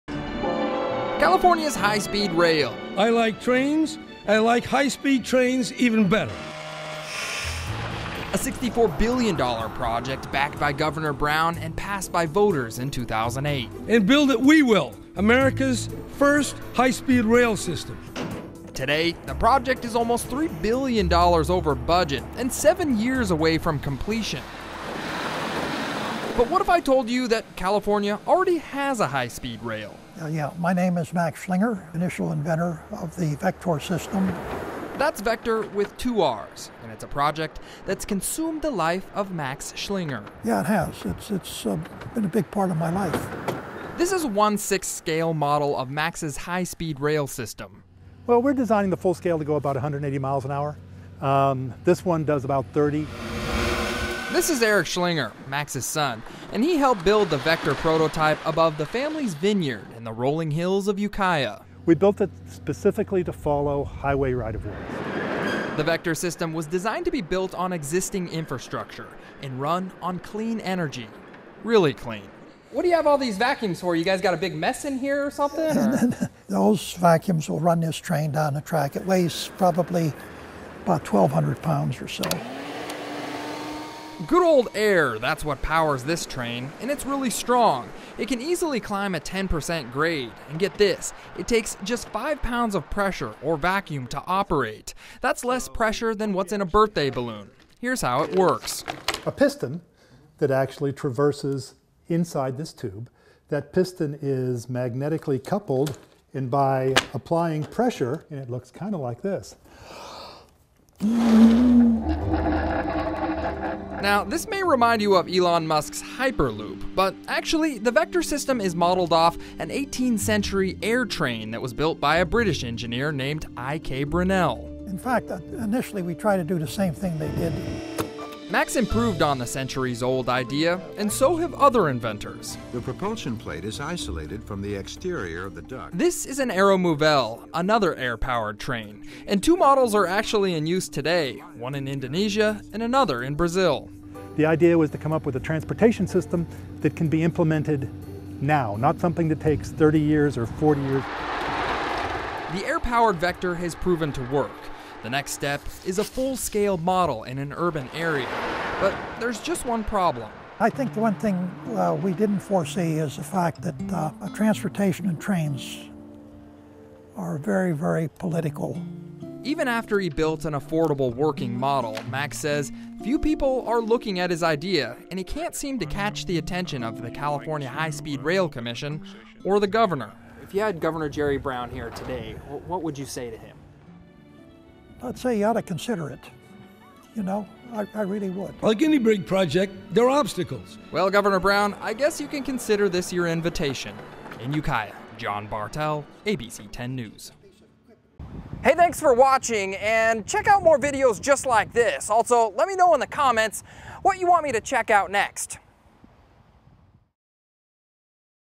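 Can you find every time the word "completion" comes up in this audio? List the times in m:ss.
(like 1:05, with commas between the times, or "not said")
0:23.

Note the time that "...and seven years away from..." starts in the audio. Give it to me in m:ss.
0:22.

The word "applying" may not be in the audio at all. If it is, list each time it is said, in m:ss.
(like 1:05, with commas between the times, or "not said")
1:47.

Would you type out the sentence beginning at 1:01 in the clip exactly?
We built it specifically to follow highway right-of-ways.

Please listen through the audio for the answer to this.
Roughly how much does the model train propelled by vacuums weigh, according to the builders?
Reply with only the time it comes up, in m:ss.
1:21.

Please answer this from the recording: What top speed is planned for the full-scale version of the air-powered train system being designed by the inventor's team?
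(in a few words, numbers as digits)
180 miles an hour.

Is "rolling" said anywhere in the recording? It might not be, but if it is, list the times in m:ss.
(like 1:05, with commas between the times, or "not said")
1:00.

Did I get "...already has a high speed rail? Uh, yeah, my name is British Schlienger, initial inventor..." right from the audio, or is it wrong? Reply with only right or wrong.
wrong.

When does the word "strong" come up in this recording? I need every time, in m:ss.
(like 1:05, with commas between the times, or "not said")
1:27.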